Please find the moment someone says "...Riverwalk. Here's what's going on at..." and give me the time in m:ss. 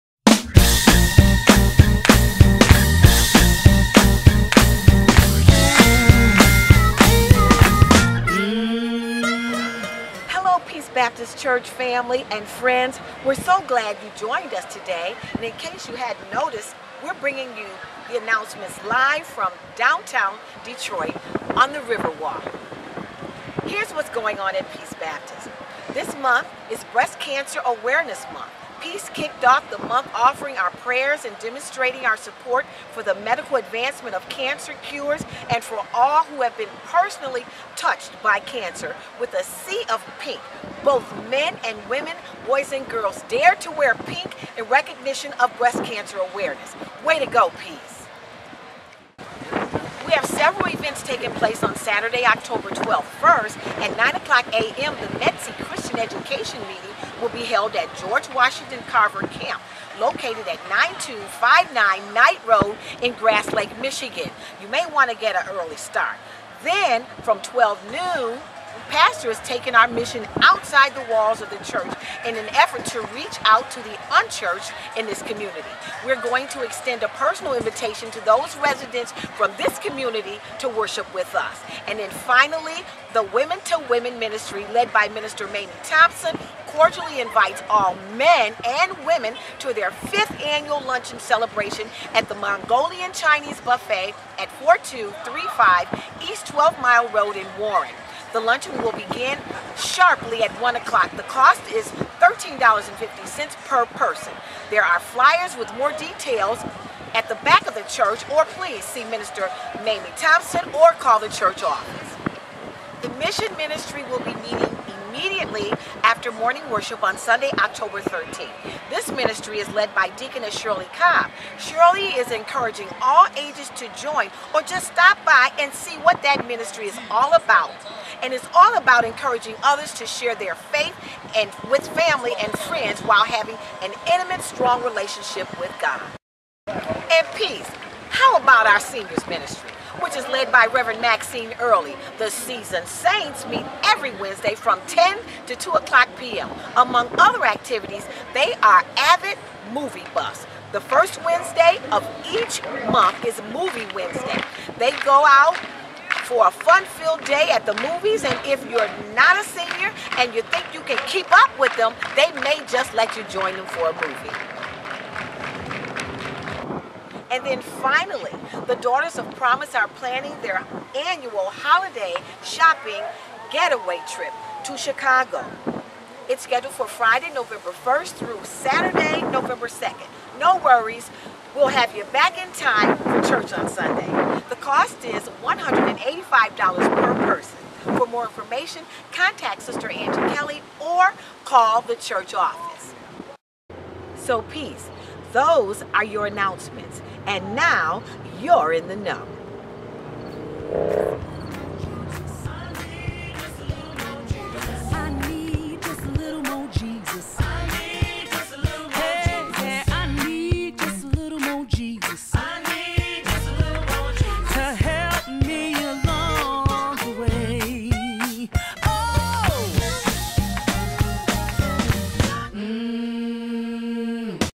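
0:21.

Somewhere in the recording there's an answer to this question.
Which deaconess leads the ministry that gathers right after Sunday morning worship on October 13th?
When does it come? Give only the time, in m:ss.
2:00.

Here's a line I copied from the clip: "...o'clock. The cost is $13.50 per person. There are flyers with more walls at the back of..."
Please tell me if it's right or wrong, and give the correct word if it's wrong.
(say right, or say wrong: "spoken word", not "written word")
wrong: "details", not "walls".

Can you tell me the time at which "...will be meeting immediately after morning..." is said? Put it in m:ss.
1:54.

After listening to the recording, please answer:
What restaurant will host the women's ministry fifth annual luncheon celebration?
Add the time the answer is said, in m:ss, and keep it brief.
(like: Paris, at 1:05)
Mongolian Chinese Buffet, at 1:32.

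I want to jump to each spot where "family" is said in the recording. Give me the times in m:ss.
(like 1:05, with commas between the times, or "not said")
0:11, 2:11.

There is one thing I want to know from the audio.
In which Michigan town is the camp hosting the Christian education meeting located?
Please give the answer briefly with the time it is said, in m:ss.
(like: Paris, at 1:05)
Grass Lake, at 1:03.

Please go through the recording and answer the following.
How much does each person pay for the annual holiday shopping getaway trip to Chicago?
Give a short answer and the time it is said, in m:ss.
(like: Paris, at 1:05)
$185, at 3:05.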